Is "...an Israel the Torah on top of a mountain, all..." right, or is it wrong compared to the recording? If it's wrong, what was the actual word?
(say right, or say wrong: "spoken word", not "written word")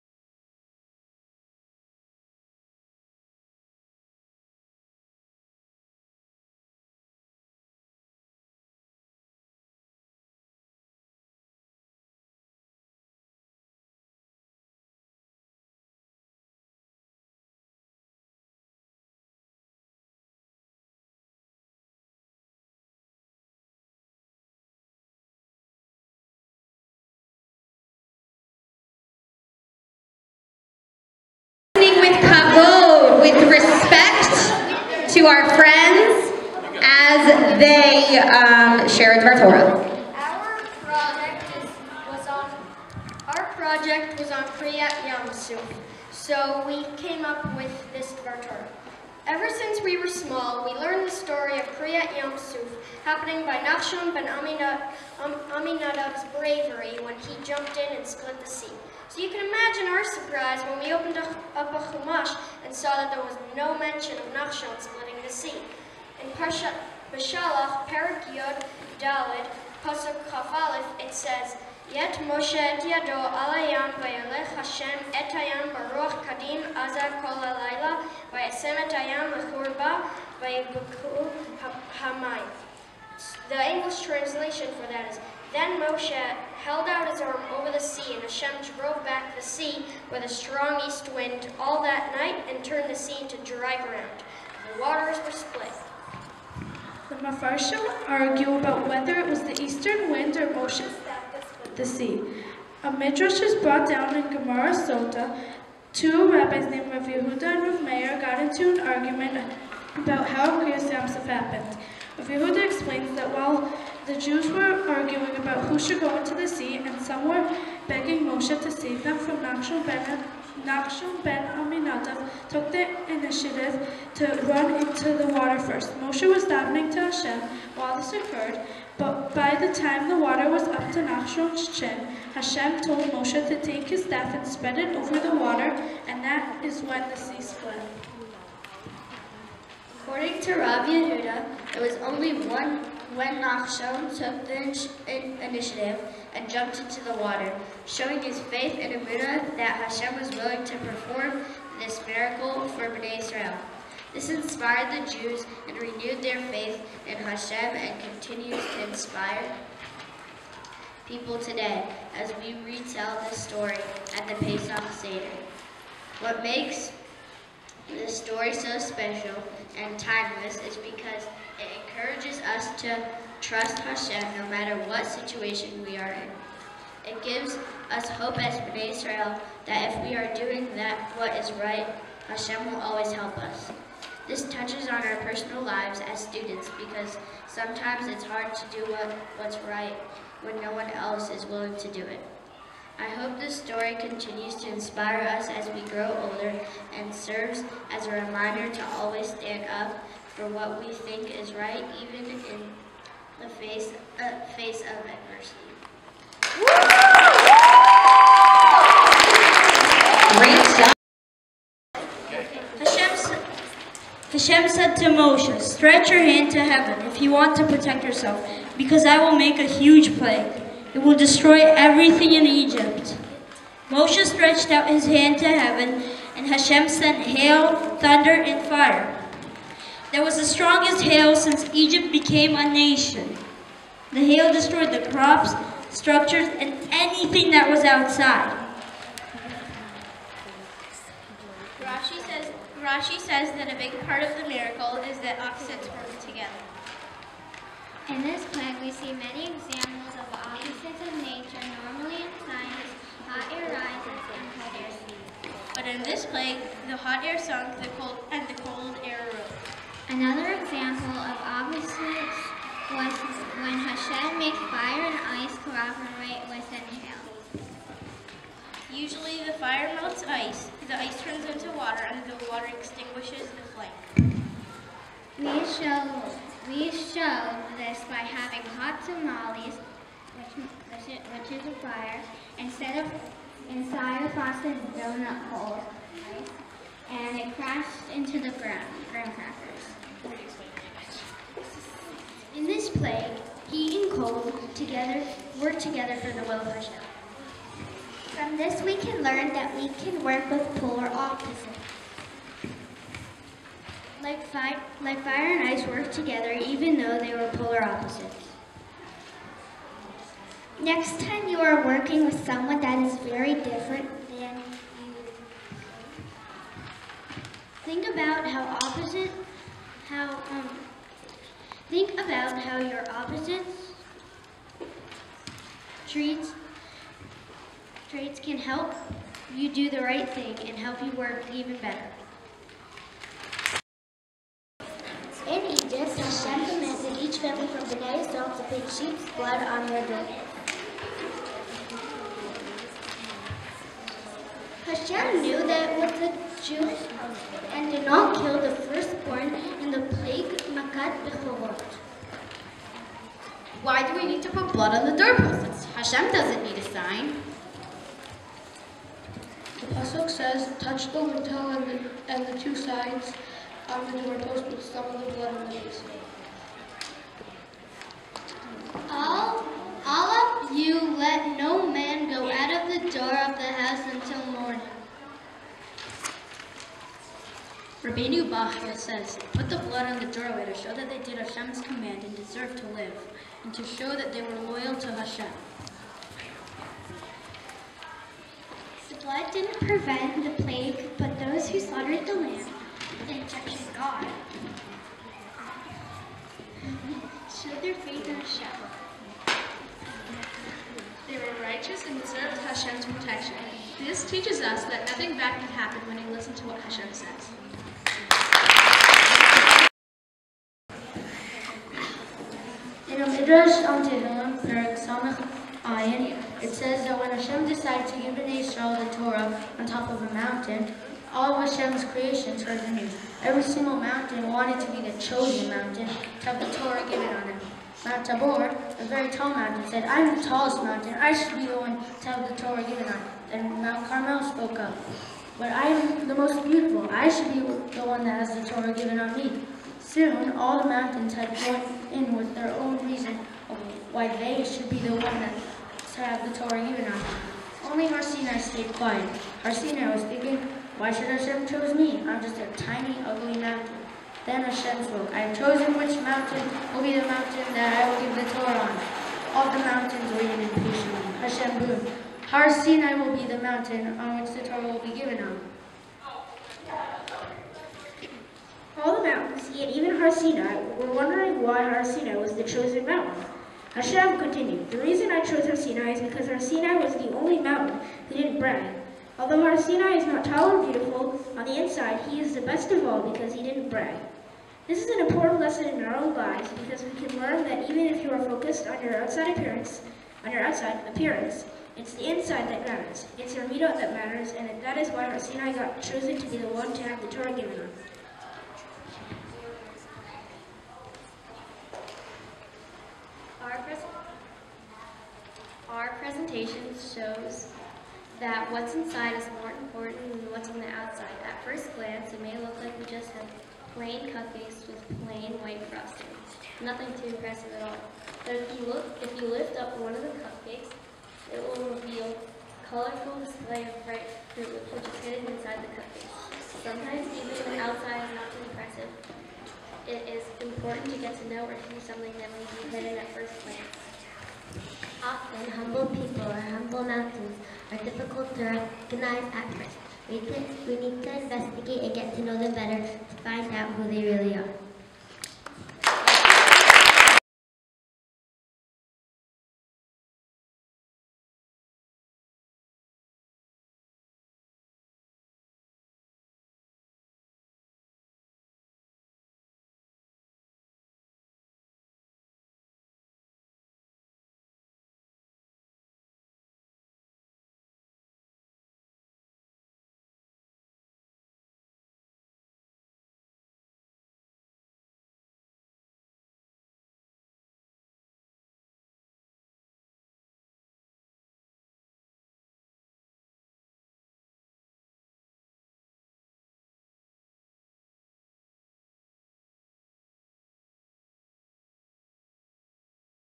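right.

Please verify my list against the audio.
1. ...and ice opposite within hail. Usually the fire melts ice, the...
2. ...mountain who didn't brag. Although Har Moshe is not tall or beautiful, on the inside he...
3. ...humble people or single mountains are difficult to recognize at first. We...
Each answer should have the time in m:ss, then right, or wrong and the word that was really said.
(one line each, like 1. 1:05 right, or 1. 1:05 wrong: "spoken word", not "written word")
1. 4:25 wrong: "cooperate", not "opposite"
2. 7:57 wrong: "Sinai", not "Moshe"
3. 8:55 wrong: "humble", not "single".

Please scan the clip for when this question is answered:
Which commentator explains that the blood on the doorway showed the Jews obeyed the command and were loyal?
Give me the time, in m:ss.
6:18.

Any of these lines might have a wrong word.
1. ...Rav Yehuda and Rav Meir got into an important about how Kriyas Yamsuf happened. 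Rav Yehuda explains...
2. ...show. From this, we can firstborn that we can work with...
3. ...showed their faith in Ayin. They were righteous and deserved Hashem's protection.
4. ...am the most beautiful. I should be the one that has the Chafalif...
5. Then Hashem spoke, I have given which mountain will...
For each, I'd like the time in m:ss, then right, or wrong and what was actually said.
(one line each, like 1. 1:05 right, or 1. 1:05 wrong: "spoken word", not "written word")
1. 1:46 wrong: "argument", not "important"
2. 4:56 wrong: "learn", not "firstborn"
3. 6:37 wrong: "Hashem", not "Ayin"
4. 7:15 wrong: "Torah", not "Chafalif"
5. 7:34 wrong: "chosen", not "given".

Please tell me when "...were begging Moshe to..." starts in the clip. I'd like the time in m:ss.
1:57.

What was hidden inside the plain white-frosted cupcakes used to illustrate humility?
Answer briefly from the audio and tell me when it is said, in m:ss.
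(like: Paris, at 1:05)
bright fruit, at 8:44.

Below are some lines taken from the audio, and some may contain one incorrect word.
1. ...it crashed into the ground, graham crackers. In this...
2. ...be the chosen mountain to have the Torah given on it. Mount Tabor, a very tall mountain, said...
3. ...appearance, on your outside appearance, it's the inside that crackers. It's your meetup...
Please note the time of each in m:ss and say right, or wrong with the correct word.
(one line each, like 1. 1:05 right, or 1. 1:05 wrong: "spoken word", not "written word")
1. 4:47 right
2. 7:04 right
3. 8:09 wrong: "matters", not "crackers".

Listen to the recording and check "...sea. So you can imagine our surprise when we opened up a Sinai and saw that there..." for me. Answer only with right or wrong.
wrong.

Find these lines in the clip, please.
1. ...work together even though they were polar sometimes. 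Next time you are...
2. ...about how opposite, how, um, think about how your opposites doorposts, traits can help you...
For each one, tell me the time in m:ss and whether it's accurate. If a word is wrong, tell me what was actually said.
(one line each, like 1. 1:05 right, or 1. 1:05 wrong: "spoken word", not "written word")
1. 5:05 wrong: "opposites", not "sometimes"
2. 5:18 wrong: "traits", not "doorposts".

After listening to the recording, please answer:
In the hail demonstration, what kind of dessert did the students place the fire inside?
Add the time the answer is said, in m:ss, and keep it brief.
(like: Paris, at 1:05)
frosted donut hole, at 4:44.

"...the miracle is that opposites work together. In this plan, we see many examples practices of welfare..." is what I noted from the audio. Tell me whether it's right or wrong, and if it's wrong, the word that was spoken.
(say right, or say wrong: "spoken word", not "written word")
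wrong: "nature", not "welfare".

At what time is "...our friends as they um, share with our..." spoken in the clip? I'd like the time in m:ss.
0:35.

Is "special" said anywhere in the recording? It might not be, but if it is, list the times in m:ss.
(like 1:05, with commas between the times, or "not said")
2:48.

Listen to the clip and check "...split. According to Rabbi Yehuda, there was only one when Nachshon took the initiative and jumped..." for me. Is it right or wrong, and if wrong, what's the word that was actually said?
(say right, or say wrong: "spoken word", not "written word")
right.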